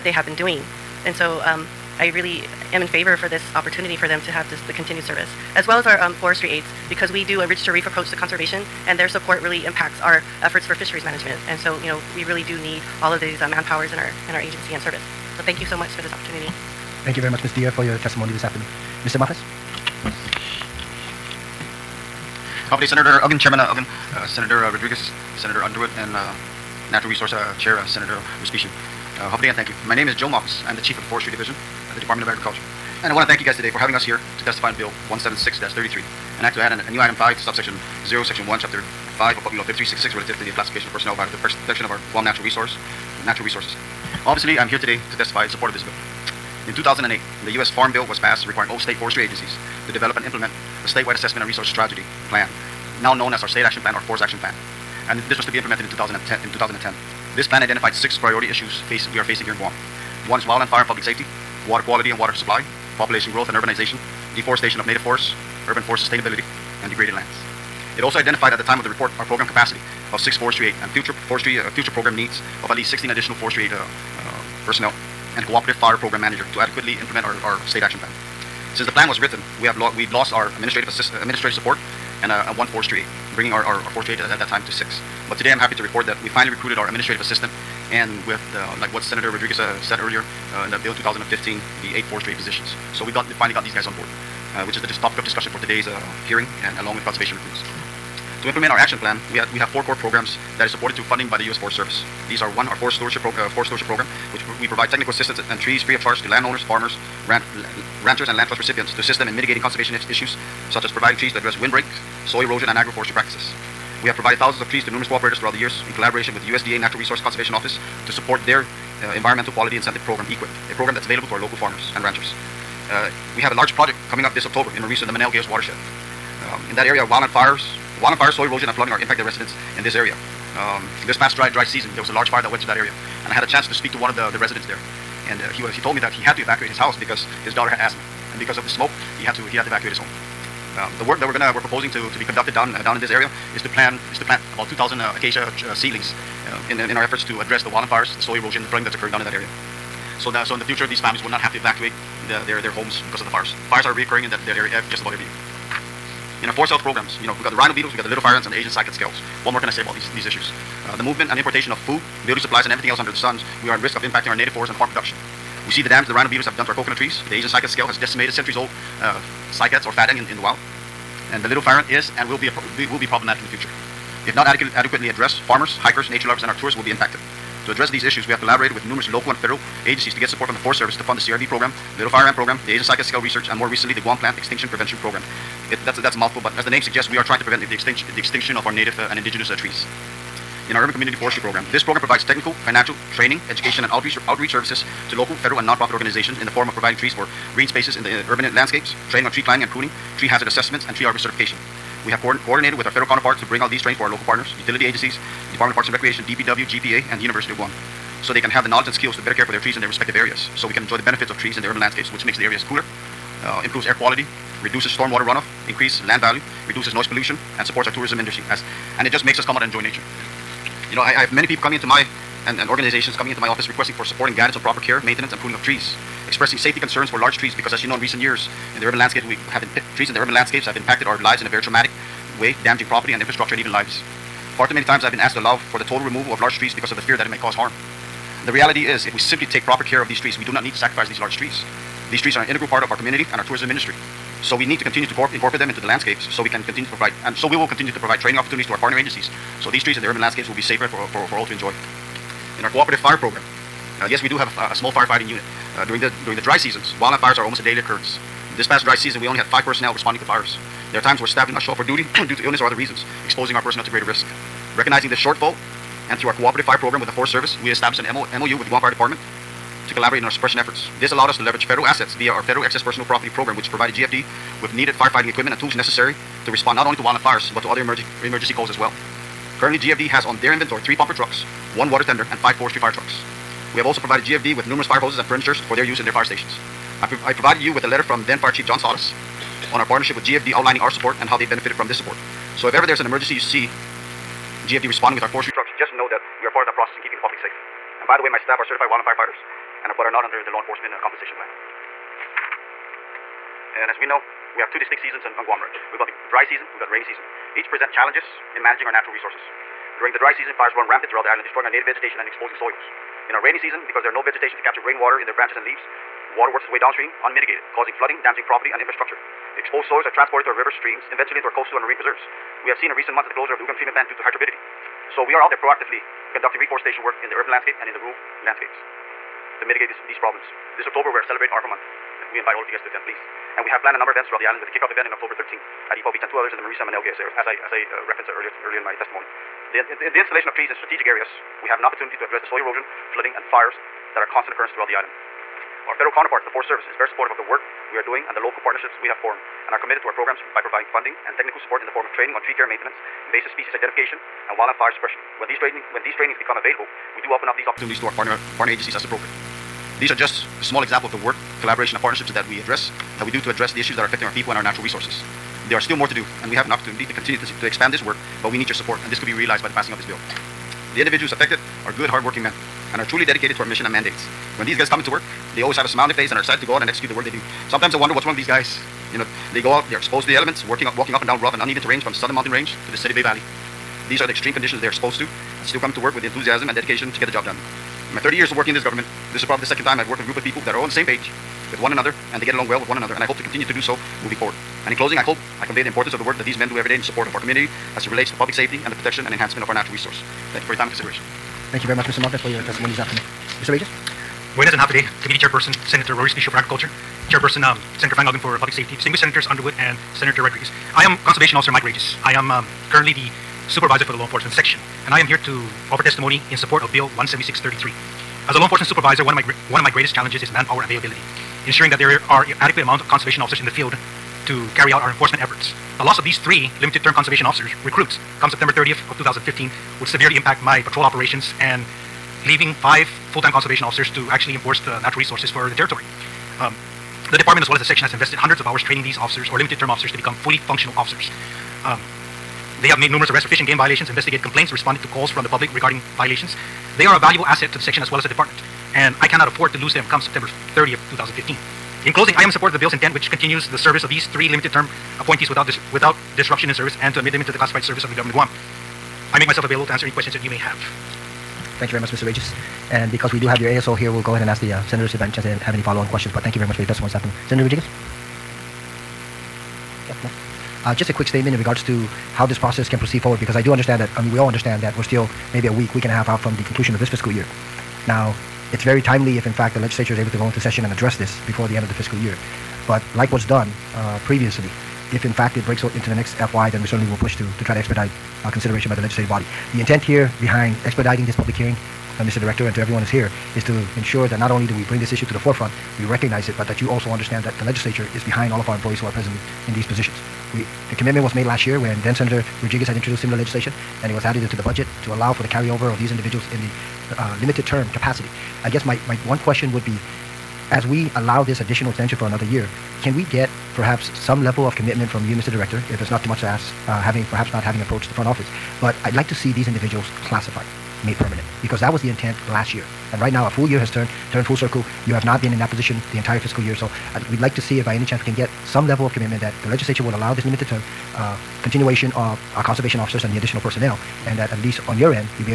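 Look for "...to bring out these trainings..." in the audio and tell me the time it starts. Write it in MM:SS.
03:23.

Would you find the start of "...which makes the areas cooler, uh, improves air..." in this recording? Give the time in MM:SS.
03:32.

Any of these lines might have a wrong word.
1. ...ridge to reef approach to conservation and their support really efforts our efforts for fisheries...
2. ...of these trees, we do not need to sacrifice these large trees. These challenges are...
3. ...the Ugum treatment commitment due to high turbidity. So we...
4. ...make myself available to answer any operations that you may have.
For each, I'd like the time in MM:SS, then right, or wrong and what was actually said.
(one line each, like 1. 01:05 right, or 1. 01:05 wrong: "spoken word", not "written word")
1. 00:07 wrong: "impacts", not "efforts"
2. 04:00 wrong: "trees", not "challenges"
3. 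05:23 wrong: "plant", not "commitment"
4. 07:39 wrong: "questions", not "operations".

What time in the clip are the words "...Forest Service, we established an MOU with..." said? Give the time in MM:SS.
04:27.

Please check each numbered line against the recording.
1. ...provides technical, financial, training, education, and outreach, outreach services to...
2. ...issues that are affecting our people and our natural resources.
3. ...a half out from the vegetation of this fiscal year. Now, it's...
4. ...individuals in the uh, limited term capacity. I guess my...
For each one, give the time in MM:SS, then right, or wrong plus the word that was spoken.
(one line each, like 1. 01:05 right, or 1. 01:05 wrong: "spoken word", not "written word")
1. 03:11 right
2. 06:03 right
3. 07:56 wrong: "conclusion", not "vegetation"
4. 08:26 right.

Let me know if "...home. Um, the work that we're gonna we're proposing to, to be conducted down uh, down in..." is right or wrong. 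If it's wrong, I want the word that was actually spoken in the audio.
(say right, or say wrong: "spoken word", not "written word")
right.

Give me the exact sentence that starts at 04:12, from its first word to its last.
In our cooperative fire program, uh, yes, we do have a, a small firefighting unit.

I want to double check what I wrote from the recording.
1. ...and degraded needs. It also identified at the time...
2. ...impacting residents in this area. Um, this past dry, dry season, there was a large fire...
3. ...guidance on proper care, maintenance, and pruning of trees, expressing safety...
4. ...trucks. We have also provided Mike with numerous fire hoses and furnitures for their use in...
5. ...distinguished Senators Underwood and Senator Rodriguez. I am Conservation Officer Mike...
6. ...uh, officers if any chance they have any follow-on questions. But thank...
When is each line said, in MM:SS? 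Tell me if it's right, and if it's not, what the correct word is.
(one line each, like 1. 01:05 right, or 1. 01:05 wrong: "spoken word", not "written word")
1. 01:06 wrong: "lands", not "needs"
2. 02:08 right
3. 03:44 right
4. 04:42 wrong: "GFD", not "Mike"
5. 06:48 right
6. 07:44 wrong: "senators", not "officers".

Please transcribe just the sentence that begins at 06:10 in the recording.
The individuals affected are good, hardworking men and are truly dedicated to our mission and mandates.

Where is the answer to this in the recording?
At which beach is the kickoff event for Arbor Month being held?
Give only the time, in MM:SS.
05:35.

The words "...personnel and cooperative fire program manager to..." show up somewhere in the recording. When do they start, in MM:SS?
01:14.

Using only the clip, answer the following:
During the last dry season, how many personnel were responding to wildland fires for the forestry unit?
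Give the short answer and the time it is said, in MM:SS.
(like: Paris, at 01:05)
5, at 04:19.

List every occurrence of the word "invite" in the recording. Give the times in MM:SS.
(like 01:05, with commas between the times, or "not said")
05:32.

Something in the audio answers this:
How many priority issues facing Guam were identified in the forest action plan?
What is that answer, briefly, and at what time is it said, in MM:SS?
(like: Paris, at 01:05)
6, at 00:57.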